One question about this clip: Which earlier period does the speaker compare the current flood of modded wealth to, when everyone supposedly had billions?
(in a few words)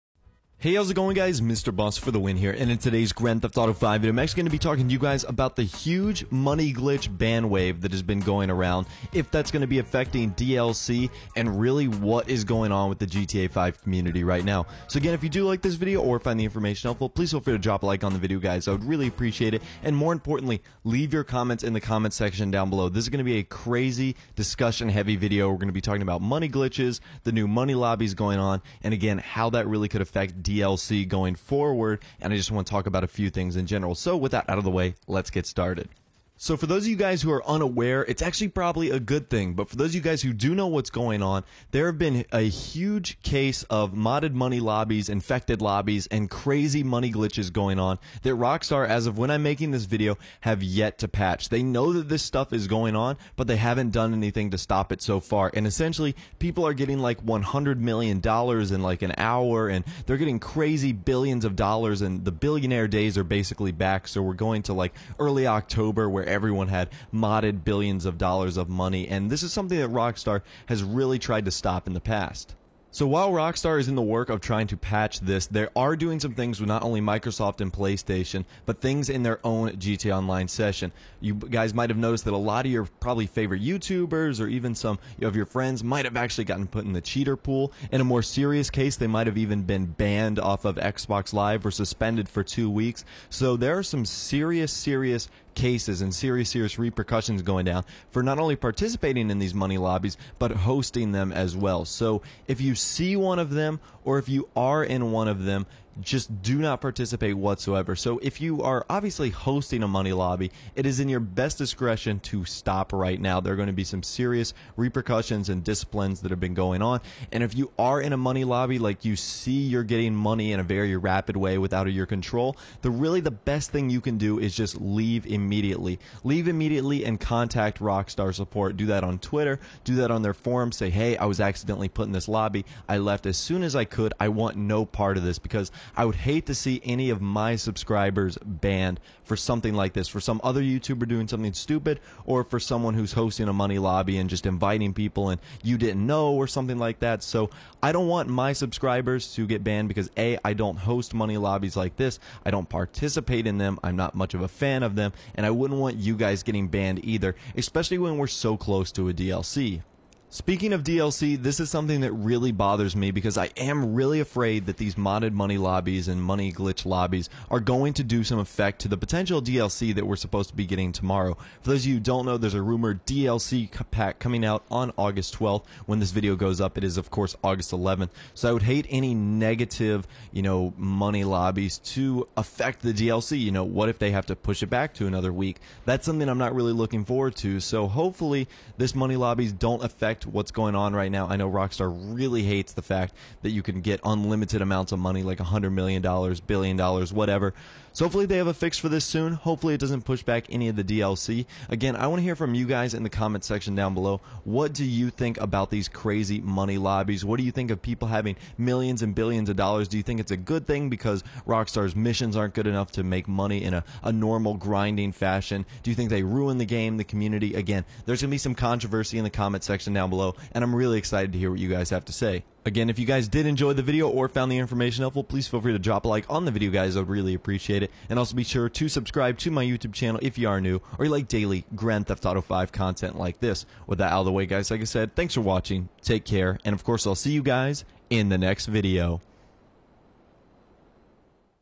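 early October.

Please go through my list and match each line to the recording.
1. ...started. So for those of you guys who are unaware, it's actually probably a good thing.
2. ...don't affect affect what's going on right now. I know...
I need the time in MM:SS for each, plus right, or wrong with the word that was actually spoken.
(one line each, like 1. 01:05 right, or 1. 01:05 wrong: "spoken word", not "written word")
1. 00:35 right
2. 03:09 right.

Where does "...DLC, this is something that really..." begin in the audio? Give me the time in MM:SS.
02:40.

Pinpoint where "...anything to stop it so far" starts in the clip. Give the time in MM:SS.
00:54.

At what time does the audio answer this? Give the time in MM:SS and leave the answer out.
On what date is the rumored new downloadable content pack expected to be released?
02:54.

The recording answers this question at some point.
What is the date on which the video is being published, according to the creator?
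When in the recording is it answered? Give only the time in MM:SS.
02:57.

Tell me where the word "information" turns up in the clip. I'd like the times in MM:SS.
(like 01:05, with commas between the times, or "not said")
00:16, 03:44.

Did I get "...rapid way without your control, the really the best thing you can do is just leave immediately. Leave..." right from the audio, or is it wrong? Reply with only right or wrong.
right.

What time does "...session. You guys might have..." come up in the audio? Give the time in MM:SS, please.
01:20.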